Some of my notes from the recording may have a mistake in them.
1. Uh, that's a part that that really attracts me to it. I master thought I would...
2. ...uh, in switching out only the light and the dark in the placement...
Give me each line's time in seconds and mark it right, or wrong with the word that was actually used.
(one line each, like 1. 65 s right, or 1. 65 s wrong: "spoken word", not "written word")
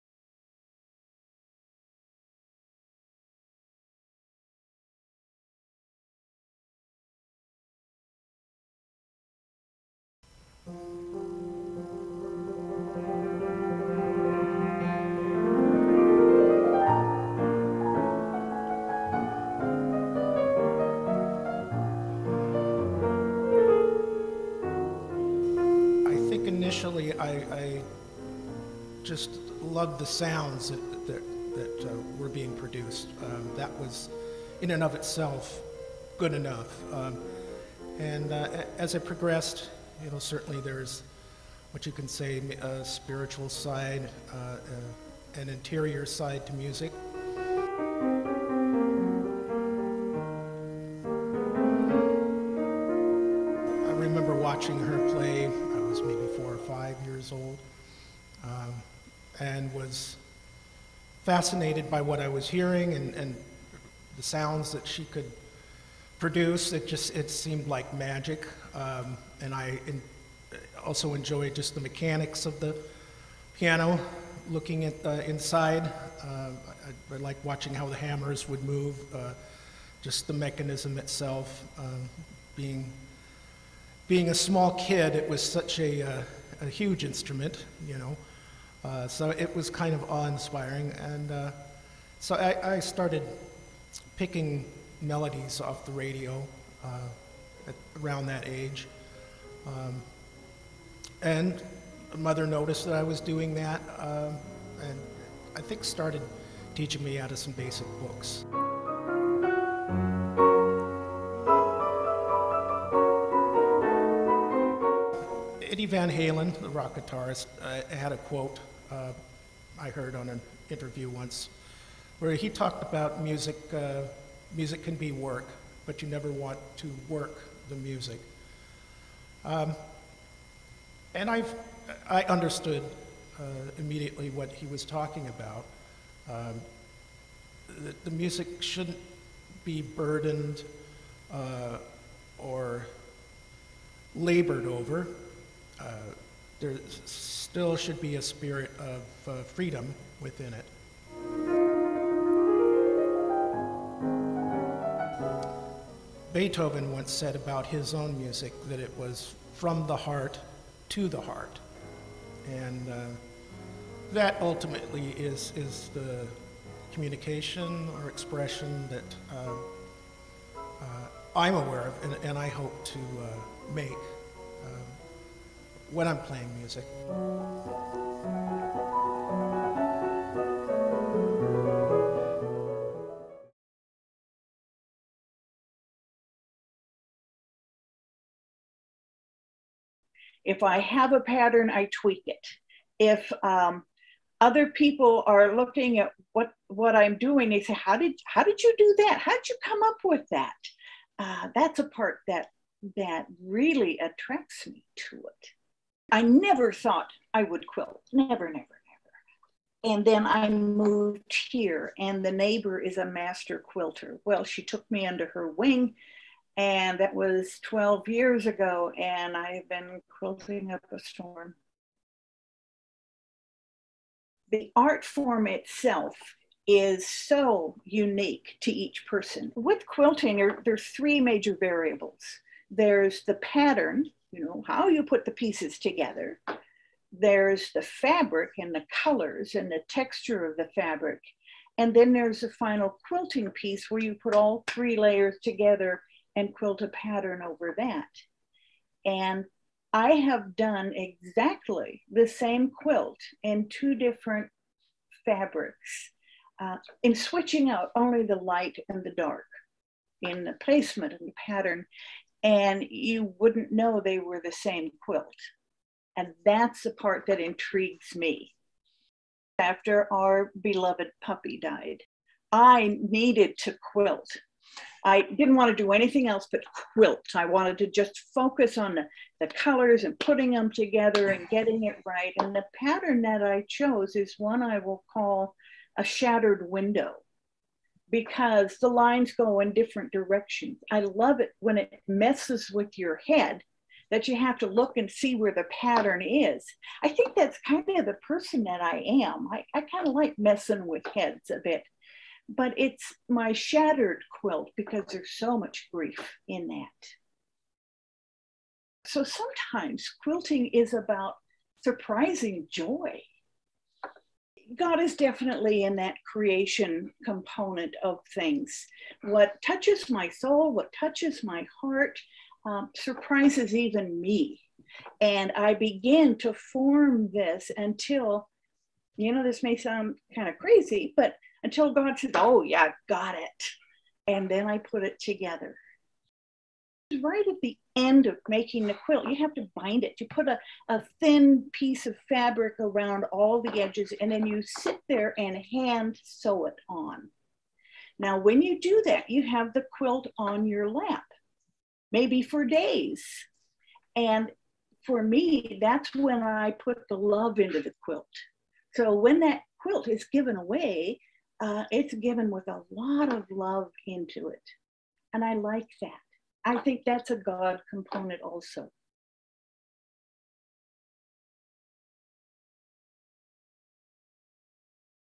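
1. 201 s wrong: "never", not "master"
2. 256 s right.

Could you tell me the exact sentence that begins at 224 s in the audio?
The art form itself is so unique to each person.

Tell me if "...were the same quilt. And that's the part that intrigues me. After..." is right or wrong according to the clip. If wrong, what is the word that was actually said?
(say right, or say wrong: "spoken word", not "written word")
right.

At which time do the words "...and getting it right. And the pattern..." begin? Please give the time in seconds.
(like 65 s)
281 s.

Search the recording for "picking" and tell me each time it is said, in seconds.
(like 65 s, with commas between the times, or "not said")
94 s.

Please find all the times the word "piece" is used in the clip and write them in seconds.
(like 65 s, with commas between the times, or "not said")
235 s, 243 s, 341 s.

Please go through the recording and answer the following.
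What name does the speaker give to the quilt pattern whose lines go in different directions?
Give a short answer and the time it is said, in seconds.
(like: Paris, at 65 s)
Shattered window, at 285 s.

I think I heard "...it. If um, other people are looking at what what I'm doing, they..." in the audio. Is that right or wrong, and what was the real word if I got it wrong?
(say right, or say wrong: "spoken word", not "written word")
right.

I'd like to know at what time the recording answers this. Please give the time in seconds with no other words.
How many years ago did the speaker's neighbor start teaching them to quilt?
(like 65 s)
217 s.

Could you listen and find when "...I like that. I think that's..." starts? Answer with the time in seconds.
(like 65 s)
365 s.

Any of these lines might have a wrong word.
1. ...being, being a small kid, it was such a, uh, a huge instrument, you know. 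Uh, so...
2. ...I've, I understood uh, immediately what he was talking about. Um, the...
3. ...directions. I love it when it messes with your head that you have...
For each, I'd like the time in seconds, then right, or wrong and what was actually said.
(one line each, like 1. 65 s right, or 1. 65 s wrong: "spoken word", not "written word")
1. 82 s right
2. 131 s right
3. 290 s right.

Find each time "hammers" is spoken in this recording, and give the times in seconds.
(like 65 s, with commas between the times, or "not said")
77 s.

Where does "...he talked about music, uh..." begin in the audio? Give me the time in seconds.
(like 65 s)
122 s.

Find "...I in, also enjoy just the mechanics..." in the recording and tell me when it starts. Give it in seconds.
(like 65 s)
69 s.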